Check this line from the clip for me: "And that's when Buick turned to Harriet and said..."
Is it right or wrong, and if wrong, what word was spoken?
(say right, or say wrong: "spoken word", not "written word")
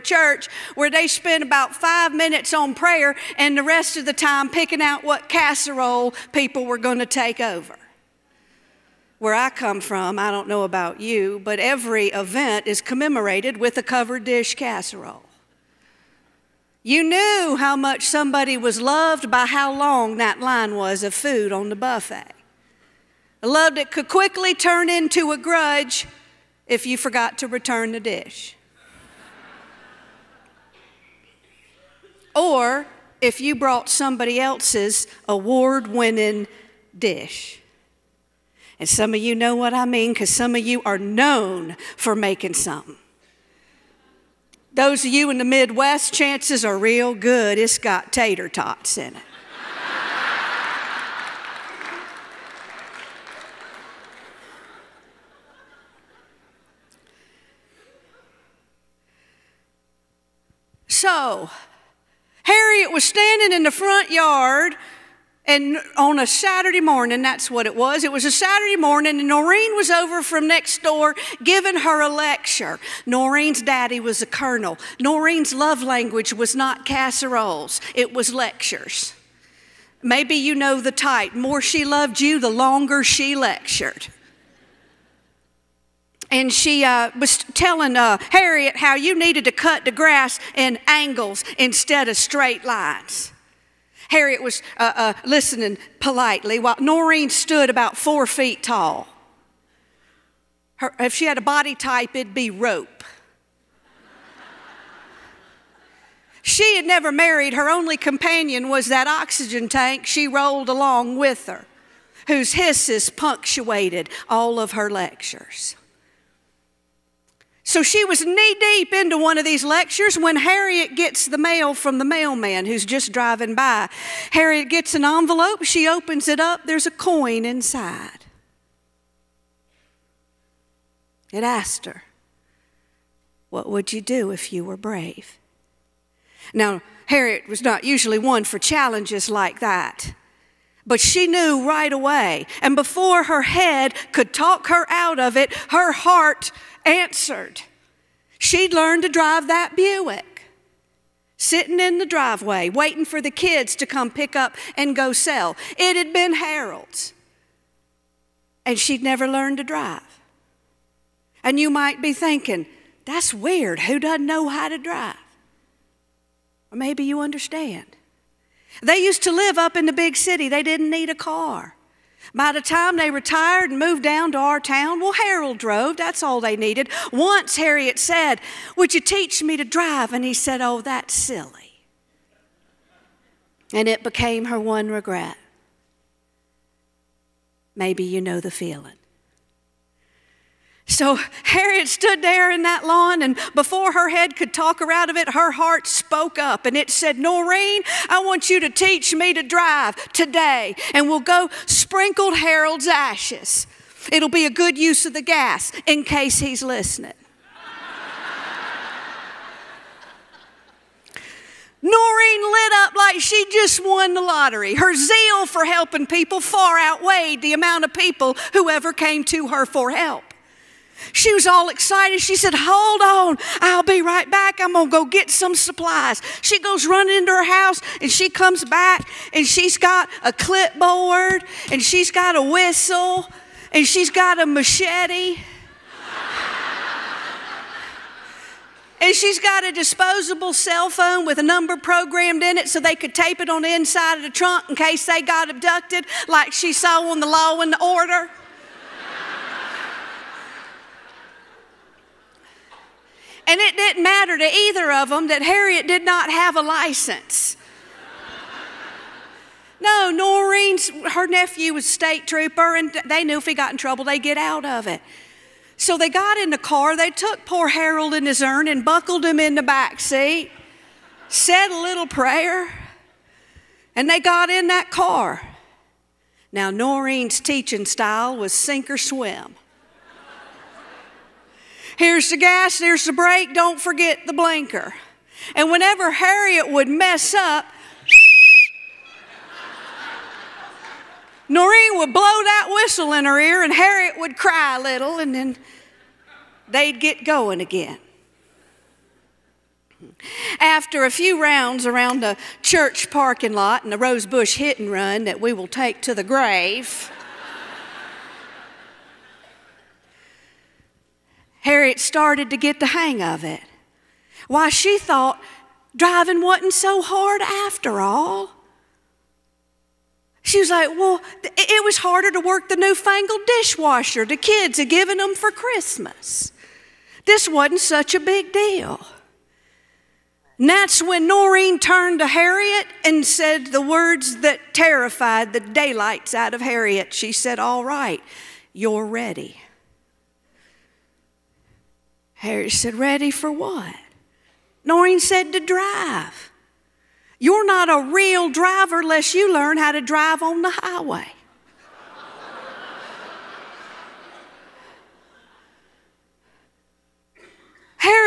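wrong: "Noreen", not "Buick".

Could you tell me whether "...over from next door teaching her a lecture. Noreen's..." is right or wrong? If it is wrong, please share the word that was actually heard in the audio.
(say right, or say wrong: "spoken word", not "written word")
wrong: "giving", not "teaching".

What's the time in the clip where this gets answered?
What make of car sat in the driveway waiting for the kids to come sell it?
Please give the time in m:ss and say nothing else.
2:29.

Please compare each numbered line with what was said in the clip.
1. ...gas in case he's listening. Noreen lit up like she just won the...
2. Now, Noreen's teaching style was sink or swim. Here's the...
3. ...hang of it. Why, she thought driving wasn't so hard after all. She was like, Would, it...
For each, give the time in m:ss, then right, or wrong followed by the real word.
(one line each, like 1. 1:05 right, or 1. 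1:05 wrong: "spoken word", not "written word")
1. 3:25 right
2. 4:36 right
3. 5:12 wrong: "Well", not "Would".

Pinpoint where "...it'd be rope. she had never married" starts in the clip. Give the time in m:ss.
1:42.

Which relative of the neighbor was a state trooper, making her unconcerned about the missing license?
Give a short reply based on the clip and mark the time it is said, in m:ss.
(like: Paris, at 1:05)
her nephew, at 4:21.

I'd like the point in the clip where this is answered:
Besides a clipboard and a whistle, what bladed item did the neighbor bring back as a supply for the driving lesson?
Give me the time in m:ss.
3:54.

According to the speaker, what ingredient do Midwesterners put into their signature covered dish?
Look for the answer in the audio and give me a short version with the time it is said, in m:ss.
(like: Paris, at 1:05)
tater tots, at 0:48.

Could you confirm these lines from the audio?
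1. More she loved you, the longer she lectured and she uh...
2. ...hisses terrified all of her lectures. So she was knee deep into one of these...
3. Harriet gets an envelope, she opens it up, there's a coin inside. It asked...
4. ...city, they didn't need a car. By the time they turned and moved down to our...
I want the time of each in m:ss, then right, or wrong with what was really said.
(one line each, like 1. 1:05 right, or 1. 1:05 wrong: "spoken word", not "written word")
1. 1:21 right
2. 1:52 wrong: "punctuated", not "terrified"
3. 2:04 right
4. 2:50 wrong: "retired", not "turned".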